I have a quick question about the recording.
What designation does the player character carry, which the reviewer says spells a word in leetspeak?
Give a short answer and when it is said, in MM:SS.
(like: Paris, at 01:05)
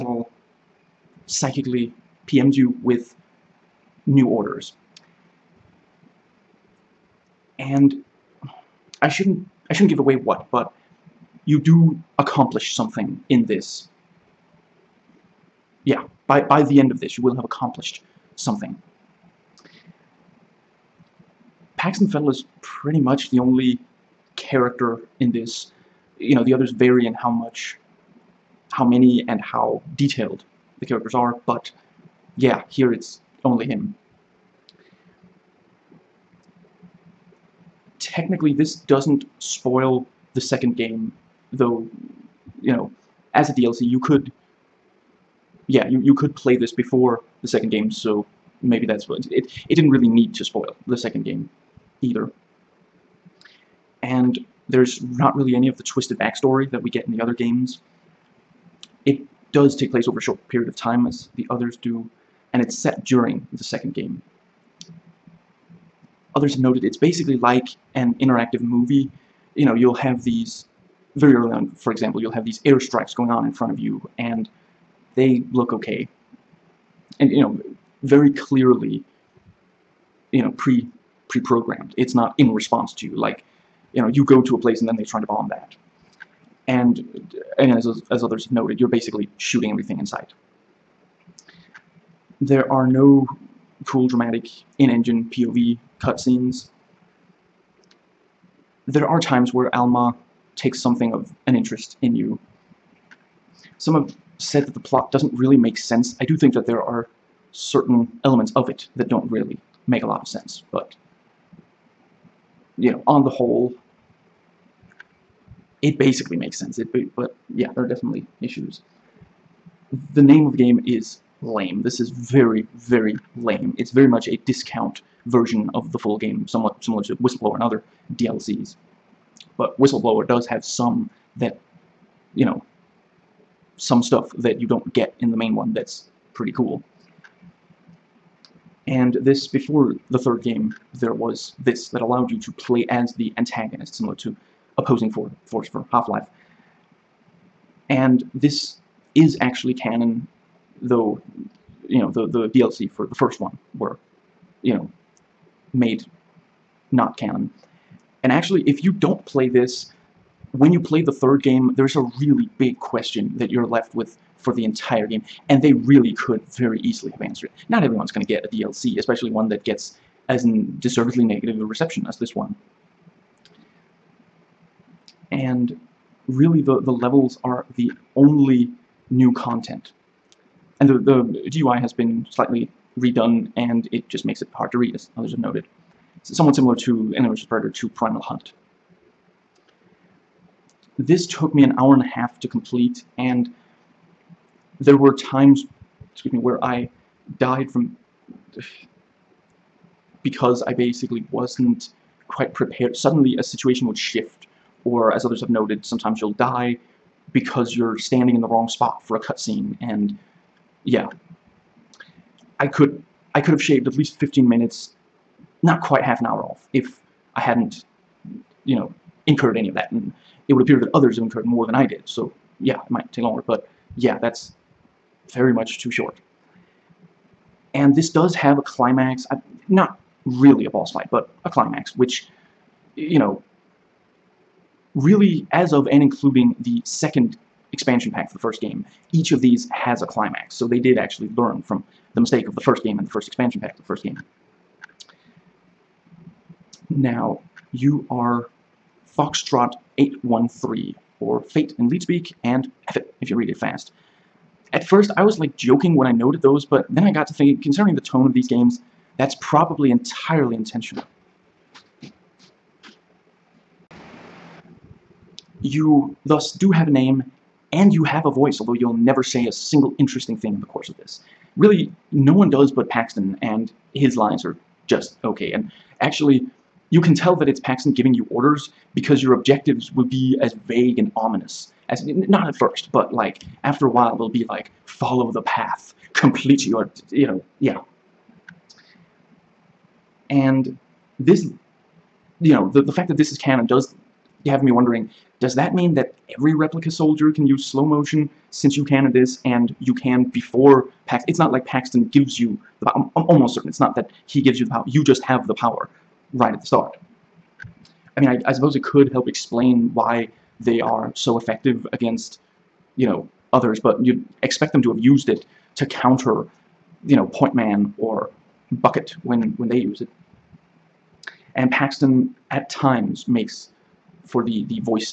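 Foxtrot 813, at 04:09.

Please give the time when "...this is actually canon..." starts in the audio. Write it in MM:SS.
02:28.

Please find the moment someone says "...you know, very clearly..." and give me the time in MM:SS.
01:17.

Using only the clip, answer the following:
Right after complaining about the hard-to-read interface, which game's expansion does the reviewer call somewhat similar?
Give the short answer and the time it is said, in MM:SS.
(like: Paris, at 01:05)
Alien vs. Predator 2 Primal Hunt, at 03:07.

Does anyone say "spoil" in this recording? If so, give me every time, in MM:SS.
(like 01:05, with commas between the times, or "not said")
00:39, 00:50.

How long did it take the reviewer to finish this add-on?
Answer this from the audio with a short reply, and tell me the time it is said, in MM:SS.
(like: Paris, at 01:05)
an hour and a half, at 03:11.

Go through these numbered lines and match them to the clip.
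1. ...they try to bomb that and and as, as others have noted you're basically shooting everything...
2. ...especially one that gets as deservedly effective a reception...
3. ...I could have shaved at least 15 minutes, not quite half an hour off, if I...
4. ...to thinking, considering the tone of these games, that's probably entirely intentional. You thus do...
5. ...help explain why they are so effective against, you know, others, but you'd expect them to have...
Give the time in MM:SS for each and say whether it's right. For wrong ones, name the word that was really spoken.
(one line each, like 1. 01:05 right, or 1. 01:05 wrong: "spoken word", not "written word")
1. 01:24 right
2. 02:48 wrong: "negative", not "effective"
3. 03:33 right
4. 04:17 right
5. 05:09 right.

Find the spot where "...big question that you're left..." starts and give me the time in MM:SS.
02:42.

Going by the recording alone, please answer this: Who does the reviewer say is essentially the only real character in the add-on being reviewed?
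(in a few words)
Paxton Fettel.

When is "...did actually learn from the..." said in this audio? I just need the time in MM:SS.
04:00.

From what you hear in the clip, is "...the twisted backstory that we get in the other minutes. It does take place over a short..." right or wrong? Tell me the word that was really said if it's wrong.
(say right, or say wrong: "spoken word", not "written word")
wrong: "games", not "minutes".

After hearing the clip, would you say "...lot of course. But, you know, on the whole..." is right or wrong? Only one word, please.
wrong.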